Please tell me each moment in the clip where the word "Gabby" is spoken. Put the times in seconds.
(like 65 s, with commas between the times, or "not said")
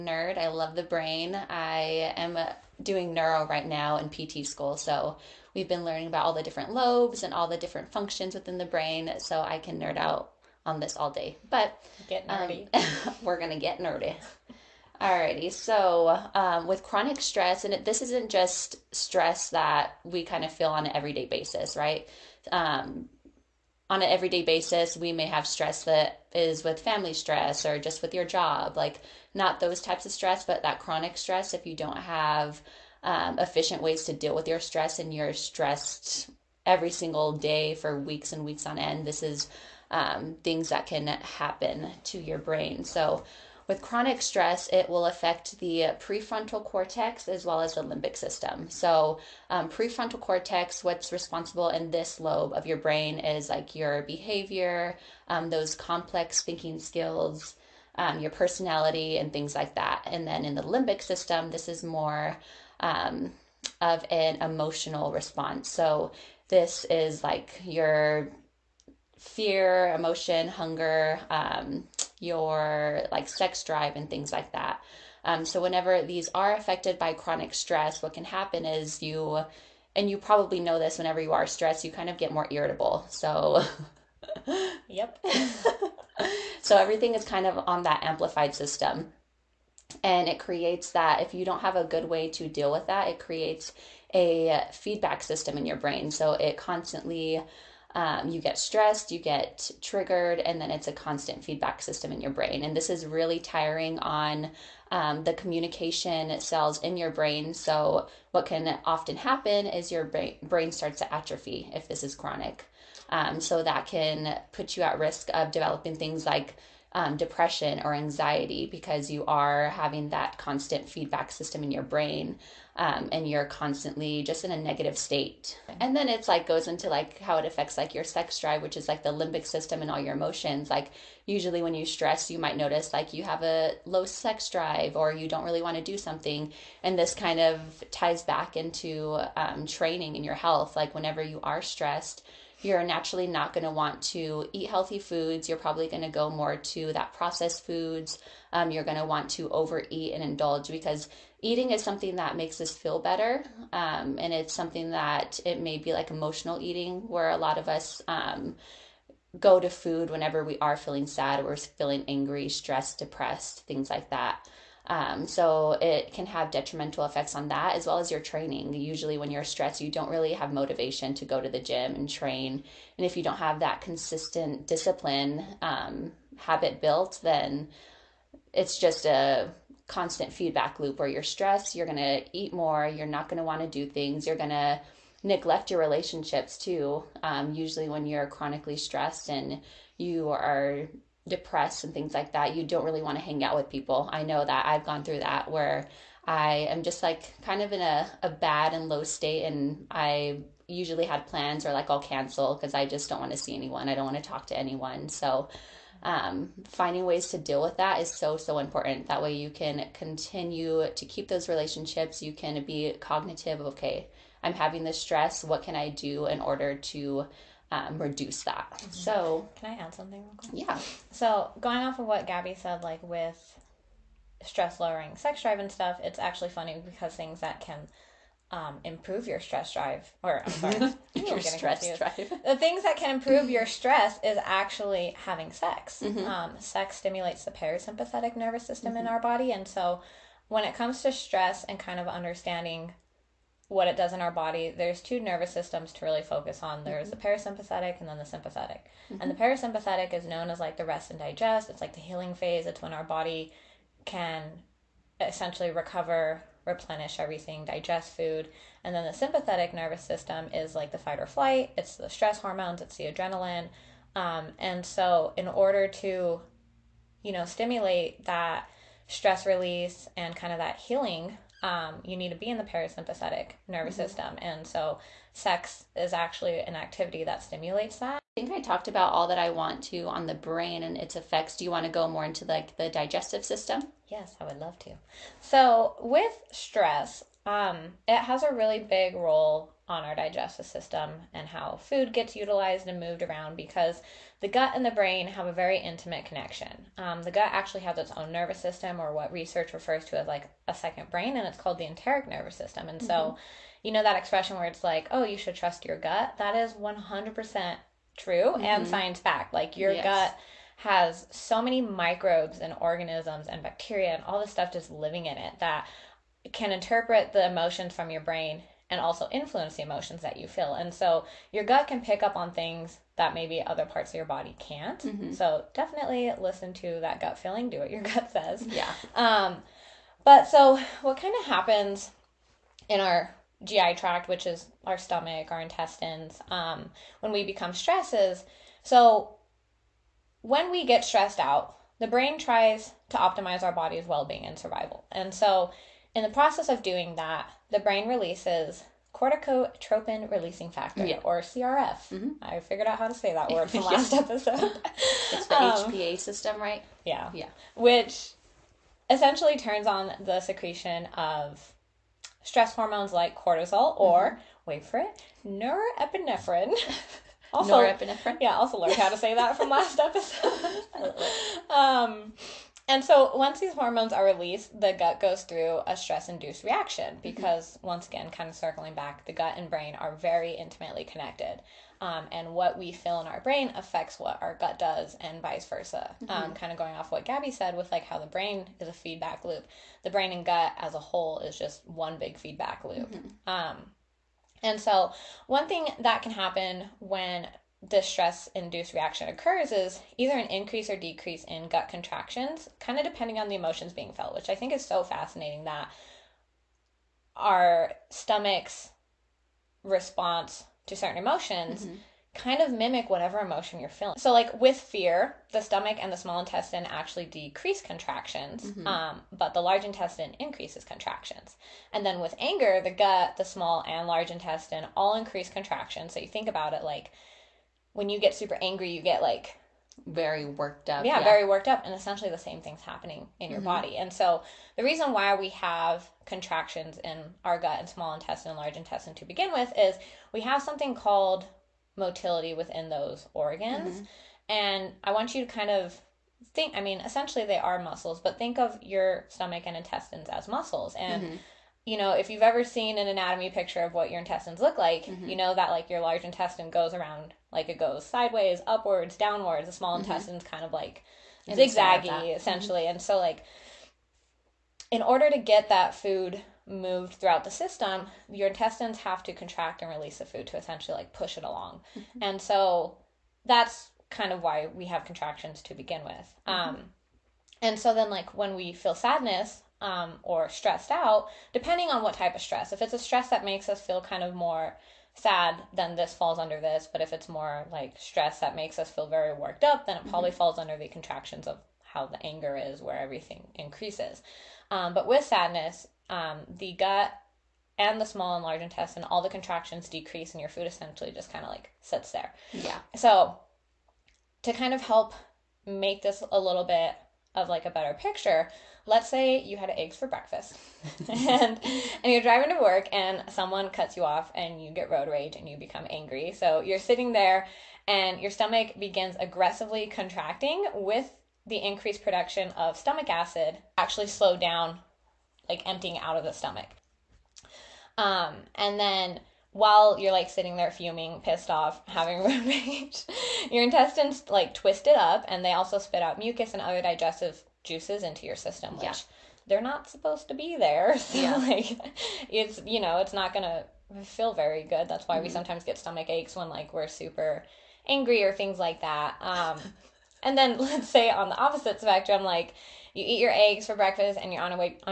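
222 s, 387 s.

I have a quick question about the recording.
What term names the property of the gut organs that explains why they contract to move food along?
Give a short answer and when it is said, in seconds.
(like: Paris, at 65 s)
motility, at 441 s.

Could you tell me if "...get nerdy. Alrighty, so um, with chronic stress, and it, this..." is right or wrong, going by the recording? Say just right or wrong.
right.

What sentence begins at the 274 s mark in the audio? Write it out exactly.
And so, sex is actually an activity that stimulates that.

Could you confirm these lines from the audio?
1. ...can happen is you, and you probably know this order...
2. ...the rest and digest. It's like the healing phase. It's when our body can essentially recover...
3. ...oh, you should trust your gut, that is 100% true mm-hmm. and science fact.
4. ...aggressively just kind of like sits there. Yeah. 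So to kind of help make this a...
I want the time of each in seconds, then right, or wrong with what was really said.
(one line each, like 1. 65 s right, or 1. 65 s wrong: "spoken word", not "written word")
1. 78 s wrong: "whenever", not "order"
2. 250 s right
3. 305 s right
4. 500 s wrong: "essentially", not "aggressively".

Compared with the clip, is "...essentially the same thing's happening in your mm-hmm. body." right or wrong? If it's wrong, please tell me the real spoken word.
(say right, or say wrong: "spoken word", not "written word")
right.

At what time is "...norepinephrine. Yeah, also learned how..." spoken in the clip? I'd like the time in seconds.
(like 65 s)
367 s.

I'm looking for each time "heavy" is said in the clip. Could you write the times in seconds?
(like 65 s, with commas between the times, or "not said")
not said.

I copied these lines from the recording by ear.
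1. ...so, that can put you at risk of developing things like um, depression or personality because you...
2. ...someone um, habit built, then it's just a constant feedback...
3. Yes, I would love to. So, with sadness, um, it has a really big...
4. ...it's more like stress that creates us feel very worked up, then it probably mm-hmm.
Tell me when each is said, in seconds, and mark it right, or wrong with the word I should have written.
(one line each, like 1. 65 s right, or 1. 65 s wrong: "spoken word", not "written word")
1. 113 s wrong: "anxiety", not "personality"
2. 174 s wrong: "discipline", not "someone"
3. 284 s wrong: "stress", not "sadness"
4. 487 s wrong: "makes", not "creates".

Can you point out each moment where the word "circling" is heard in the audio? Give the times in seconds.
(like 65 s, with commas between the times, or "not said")
378 s.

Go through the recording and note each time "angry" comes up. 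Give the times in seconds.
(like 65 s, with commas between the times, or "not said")
162 s, 428 s, 515 s, 547 s.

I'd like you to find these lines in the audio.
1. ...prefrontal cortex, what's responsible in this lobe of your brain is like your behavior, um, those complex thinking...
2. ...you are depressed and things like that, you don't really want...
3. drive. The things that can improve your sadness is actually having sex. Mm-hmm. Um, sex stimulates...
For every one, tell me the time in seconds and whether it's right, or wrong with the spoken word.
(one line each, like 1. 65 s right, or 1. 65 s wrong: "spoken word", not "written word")
1. 49 s right
2. 189 s right
3. 232 s wrong: "stress", not "sadness".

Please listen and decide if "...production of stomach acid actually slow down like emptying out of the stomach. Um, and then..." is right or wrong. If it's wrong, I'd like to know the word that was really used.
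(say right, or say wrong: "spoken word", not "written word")
right.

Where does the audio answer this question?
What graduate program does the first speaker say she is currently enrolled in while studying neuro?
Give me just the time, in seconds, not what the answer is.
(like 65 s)
4 s.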